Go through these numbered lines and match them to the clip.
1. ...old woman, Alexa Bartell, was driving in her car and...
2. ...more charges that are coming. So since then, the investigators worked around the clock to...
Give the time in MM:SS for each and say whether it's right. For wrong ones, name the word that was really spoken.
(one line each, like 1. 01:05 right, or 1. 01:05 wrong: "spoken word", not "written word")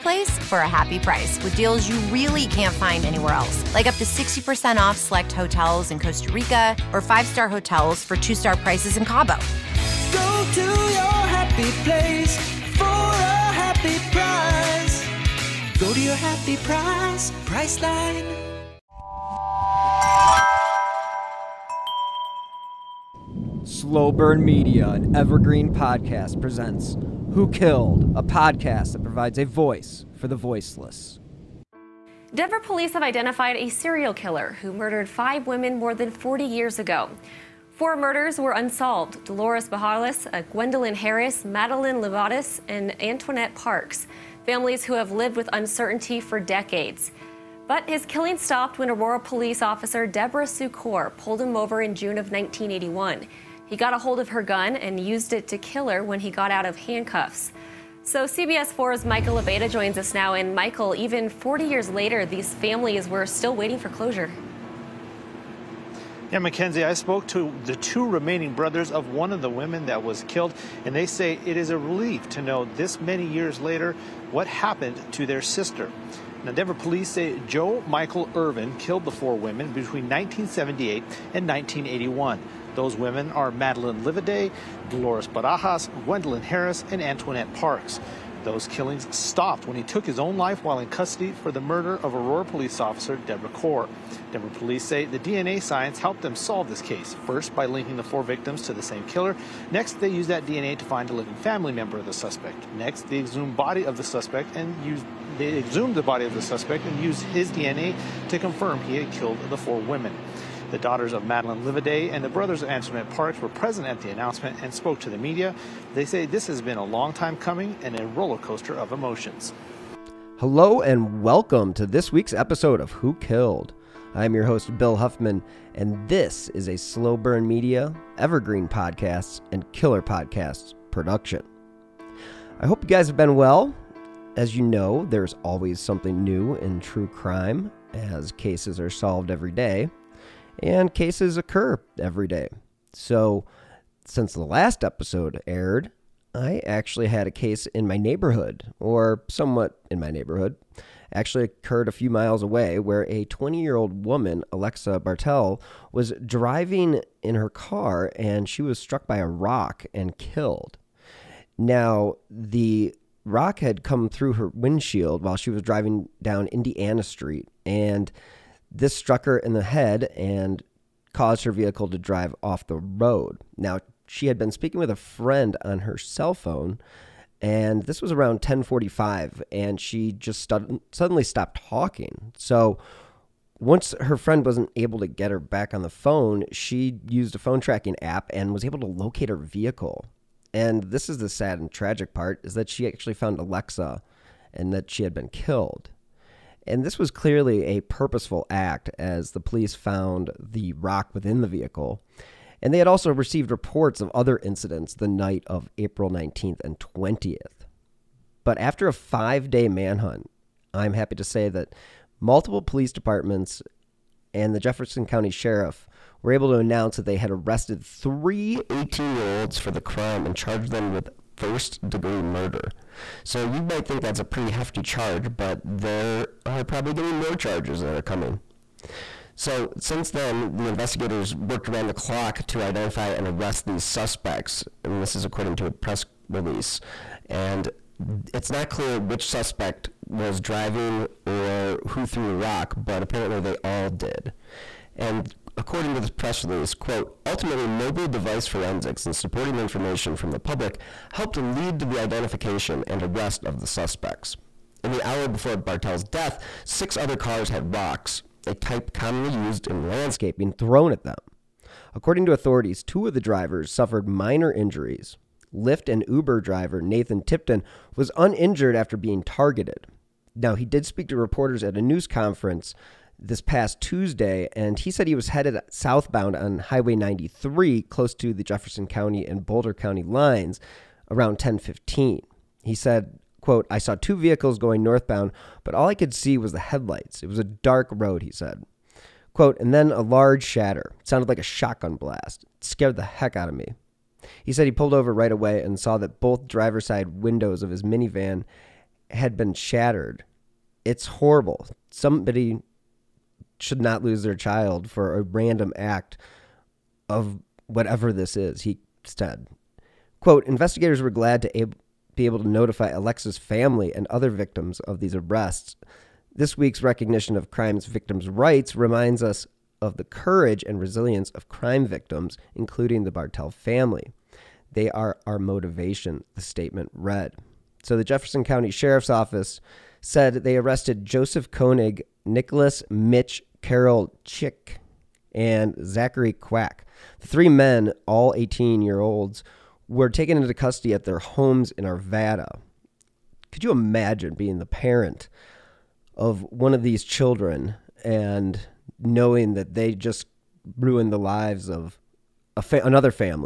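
1. 02:33 right
2. 03:47 right.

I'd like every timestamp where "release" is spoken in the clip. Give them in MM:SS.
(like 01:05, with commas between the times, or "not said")
03:56, 04:06.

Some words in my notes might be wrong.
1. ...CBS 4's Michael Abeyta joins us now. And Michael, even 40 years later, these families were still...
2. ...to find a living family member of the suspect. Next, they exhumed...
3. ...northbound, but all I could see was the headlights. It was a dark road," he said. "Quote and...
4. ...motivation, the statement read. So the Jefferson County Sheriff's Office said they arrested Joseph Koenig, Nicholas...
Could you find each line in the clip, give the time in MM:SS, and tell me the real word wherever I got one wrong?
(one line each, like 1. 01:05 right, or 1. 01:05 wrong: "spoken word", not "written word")
1. 00:58 right
2. 01:40 right
3. 04:44 right
4. 05:25 right.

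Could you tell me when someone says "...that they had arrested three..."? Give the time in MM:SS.
03:36.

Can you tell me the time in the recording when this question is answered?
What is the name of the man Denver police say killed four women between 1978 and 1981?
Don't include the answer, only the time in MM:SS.
01:17.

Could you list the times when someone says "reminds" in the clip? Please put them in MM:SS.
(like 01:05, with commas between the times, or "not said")
05:18.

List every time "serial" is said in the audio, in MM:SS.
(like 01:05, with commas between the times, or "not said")
00:33.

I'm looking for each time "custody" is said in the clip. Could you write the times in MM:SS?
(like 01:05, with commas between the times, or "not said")
01:30, 05:40.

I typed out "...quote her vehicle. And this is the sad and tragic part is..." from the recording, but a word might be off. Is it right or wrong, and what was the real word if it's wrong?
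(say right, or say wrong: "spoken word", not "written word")
wrong: "locate", not "quote".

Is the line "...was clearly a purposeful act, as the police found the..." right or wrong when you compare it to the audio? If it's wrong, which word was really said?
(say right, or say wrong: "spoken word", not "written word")
right.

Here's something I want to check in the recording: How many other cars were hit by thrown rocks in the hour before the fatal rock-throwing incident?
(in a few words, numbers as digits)
6.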